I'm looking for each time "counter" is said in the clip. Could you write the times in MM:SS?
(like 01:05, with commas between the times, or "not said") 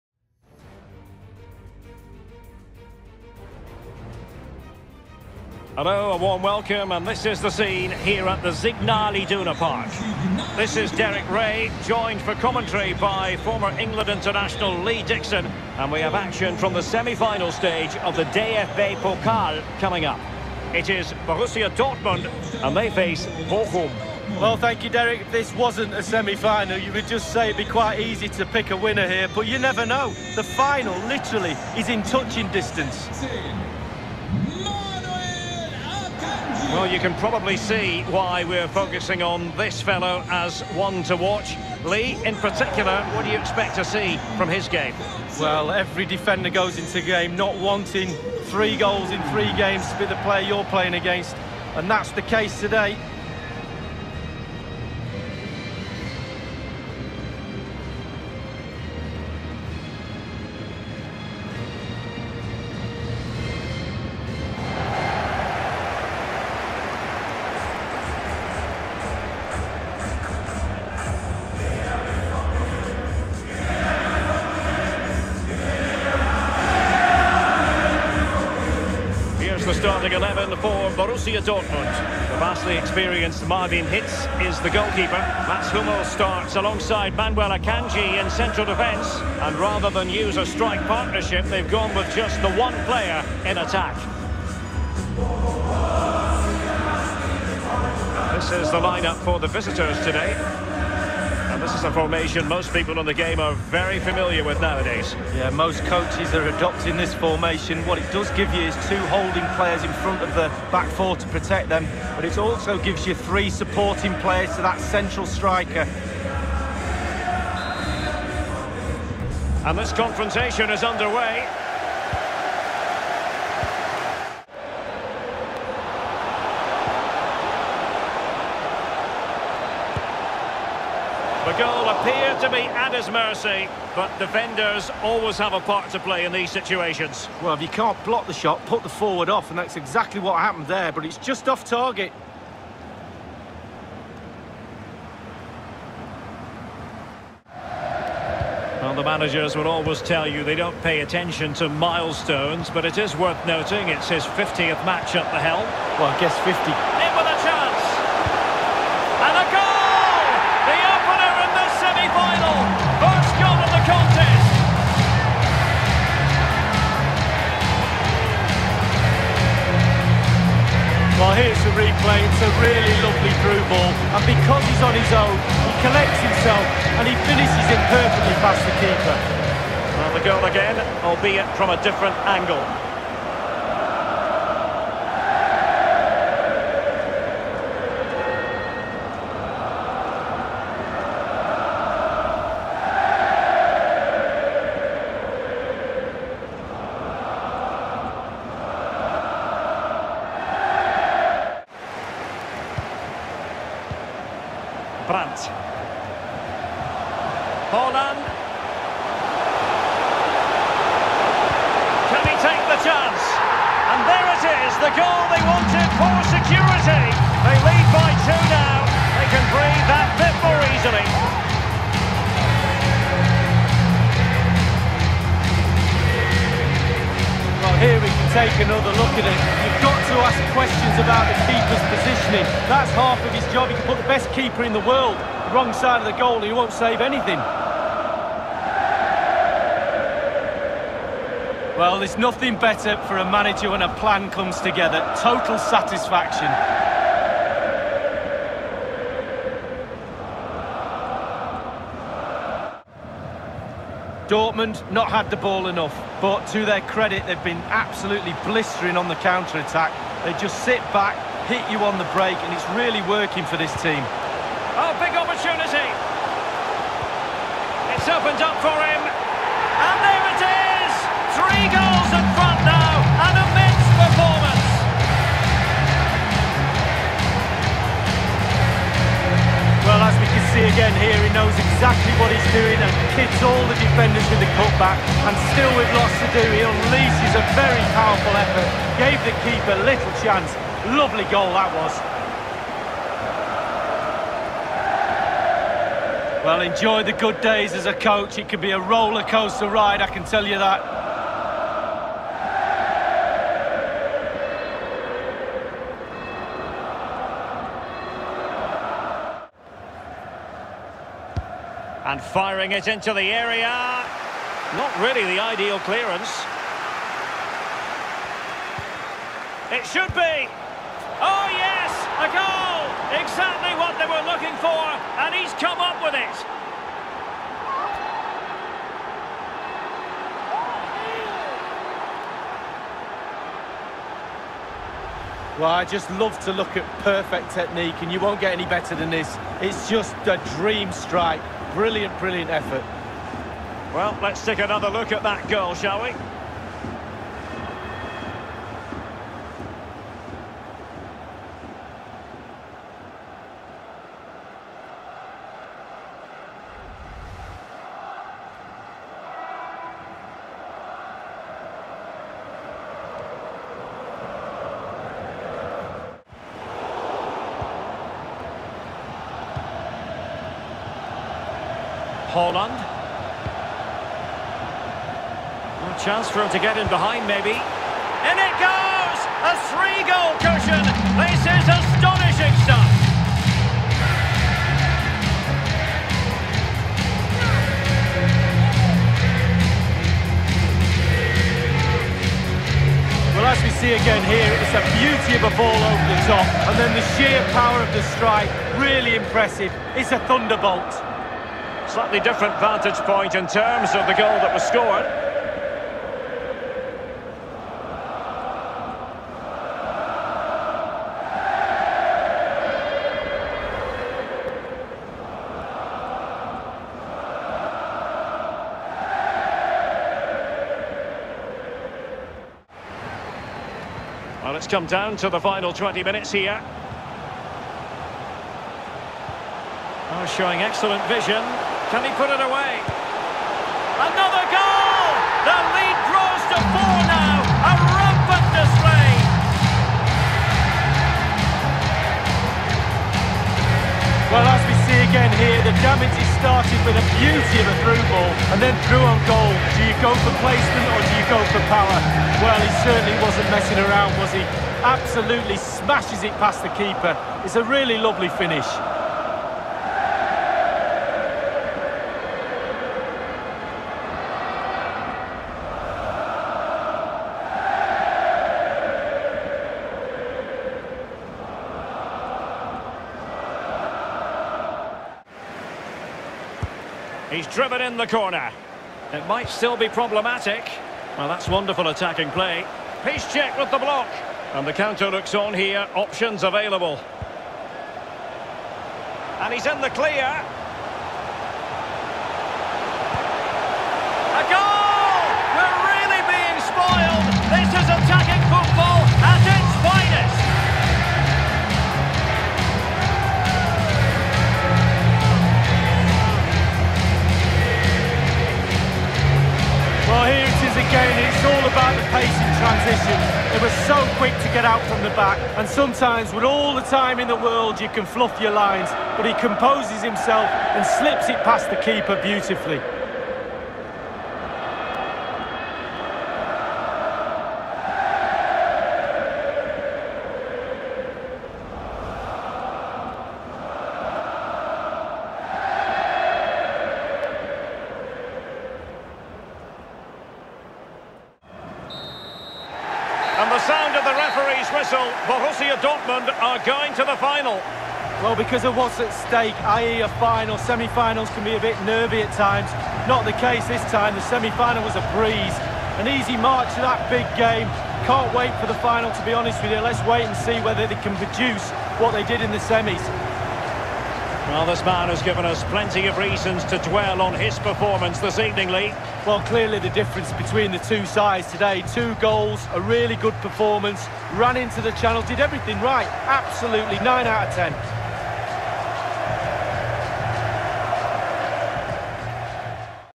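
04:19, 08:04.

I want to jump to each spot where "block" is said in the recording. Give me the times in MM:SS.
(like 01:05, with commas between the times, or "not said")
02:18, 08:03.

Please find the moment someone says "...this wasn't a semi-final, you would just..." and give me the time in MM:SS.
00:25.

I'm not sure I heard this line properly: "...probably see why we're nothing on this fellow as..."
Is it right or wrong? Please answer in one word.
wrong.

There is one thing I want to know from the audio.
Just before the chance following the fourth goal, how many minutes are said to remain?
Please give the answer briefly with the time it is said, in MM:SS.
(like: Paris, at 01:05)
20, at 07:05.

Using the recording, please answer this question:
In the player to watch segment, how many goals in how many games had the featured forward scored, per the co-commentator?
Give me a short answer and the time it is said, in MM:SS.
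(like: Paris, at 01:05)
3 goals in 3 games, at 00:48.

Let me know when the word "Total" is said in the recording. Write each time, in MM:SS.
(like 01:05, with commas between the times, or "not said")
04:05.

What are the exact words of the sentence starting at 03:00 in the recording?
And the goal again, albeit from a different angle.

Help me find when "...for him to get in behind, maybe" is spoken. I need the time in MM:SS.
06:16.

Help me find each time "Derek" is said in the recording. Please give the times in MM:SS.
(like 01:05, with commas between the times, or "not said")
00:10, 00:24.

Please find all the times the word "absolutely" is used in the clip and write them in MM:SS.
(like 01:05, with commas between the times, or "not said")
04:17, 07:34, 09:36.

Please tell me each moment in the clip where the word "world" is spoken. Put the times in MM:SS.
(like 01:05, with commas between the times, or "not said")
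03:54, 08:37.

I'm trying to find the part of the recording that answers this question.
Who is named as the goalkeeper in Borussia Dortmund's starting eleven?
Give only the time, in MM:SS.
01:23.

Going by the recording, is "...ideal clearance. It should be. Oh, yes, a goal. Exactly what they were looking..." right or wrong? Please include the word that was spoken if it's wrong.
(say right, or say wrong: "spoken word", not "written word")
right.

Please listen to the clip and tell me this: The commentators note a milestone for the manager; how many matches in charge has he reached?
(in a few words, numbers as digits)
50.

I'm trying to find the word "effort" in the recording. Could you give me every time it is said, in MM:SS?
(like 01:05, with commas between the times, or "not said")
04:48, 05:42.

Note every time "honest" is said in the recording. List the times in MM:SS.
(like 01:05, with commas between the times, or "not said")
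09:19.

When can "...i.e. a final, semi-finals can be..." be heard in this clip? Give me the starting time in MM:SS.
09:09.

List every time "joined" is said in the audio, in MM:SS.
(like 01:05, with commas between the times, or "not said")
00:11.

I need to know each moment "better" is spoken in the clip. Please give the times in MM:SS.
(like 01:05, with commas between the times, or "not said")
04:02, 05:38.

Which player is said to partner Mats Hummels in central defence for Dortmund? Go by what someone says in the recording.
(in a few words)
Manuel Akanji.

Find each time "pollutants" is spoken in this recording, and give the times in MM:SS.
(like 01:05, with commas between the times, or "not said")
not said.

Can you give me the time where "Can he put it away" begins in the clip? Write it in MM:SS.
07:11.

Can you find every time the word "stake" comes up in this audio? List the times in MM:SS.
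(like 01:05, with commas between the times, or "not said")
09:09.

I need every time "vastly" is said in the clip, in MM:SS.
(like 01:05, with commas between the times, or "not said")
01:22.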